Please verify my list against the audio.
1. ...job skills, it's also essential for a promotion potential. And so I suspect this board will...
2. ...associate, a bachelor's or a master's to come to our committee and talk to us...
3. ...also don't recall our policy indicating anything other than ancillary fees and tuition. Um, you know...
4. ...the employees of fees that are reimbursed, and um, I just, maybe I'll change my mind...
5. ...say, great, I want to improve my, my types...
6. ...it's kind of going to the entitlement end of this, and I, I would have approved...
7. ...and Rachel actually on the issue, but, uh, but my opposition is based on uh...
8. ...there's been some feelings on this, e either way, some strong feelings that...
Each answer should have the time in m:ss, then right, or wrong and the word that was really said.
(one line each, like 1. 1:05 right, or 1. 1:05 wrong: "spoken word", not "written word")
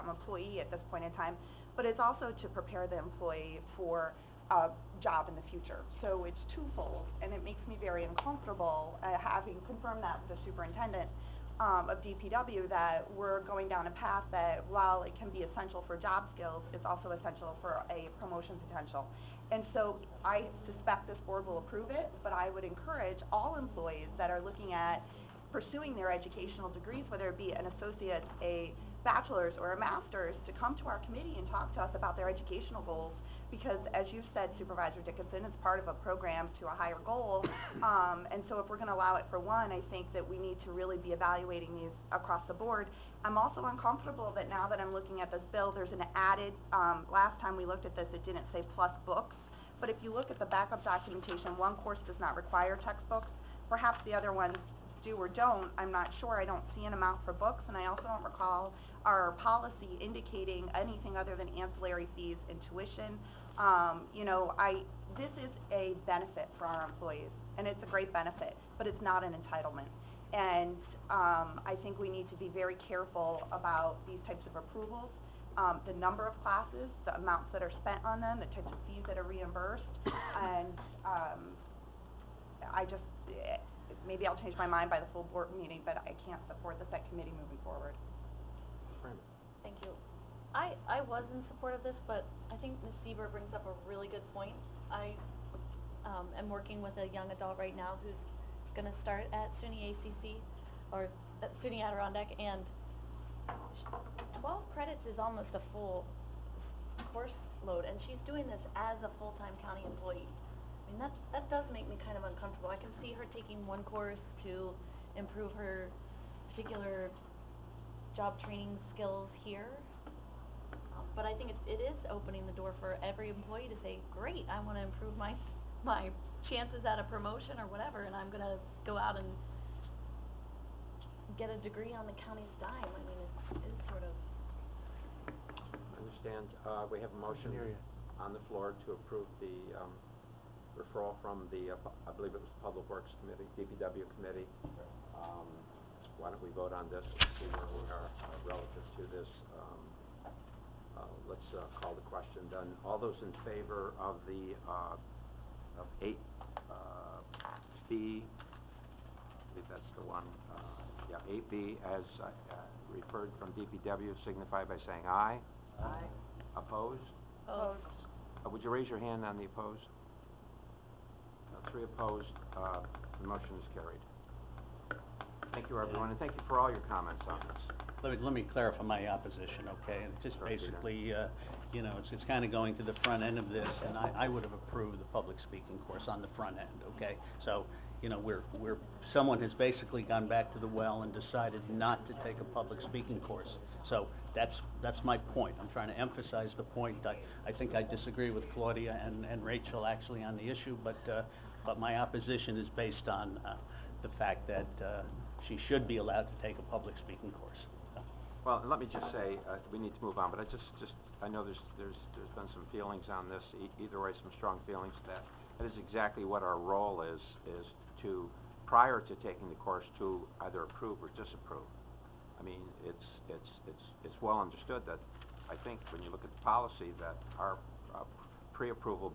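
1. 0:15 right
2. 0:27 right
3. 0:57 right
4. 1:18 wrong: "types", not "employees"
5. 2:03 wrong: "chances", not "types"
6. 3:02 wrong: "front", not "entitlement"
7. 3:19 right
8. 3:32 right.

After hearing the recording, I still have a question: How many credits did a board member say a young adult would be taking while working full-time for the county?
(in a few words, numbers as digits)
12.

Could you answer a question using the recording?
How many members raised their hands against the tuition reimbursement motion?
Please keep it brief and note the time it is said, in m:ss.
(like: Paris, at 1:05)
3, at 2:51.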